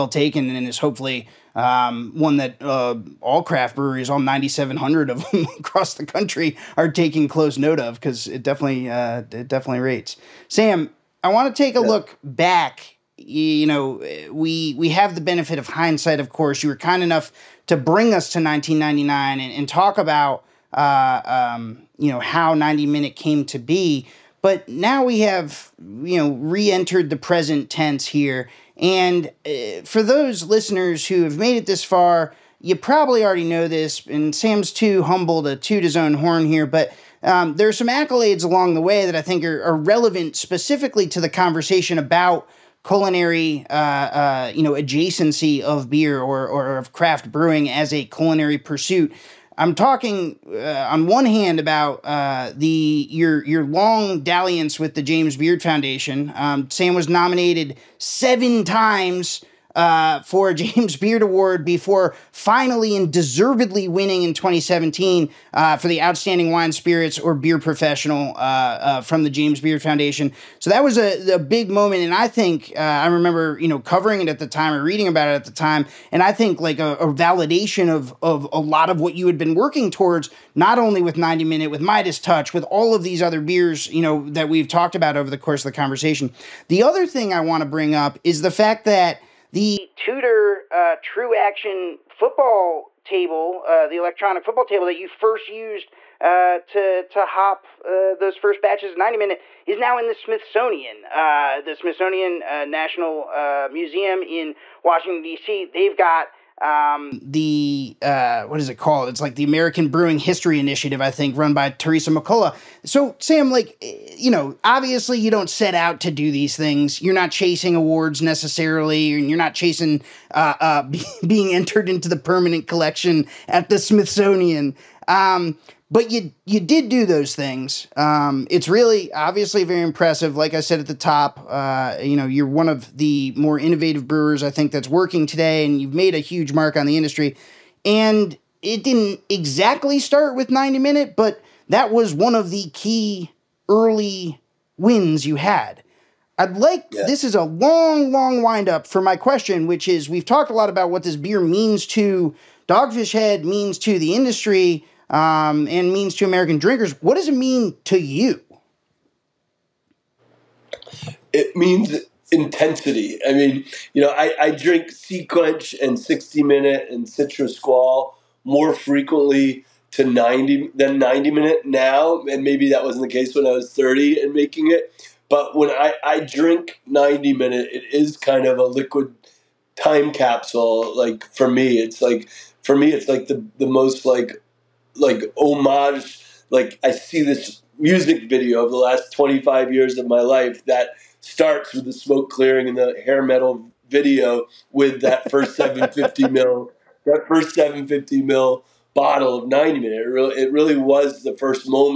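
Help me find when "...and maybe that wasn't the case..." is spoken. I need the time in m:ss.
2:52.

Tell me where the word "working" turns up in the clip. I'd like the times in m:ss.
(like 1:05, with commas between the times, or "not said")
1:19, 2:14.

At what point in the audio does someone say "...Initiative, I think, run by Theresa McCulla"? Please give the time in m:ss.
1:50.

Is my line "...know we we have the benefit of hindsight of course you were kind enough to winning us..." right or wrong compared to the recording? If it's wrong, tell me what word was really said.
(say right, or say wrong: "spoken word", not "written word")
wrong: "bring", not "winning".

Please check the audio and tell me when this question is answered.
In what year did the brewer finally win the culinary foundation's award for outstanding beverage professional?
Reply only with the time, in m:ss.
1:04.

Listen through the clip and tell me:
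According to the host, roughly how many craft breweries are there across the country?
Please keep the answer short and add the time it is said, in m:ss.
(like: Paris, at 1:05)
9,700, at 0:04.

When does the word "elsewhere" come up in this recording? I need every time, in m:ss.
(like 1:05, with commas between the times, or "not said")
not said.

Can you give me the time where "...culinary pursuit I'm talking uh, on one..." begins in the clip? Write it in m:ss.
0:48.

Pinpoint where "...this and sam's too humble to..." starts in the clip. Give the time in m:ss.
0:33.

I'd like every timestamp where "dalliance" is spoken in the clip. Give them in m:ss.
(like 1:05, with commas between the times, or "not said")
0:54.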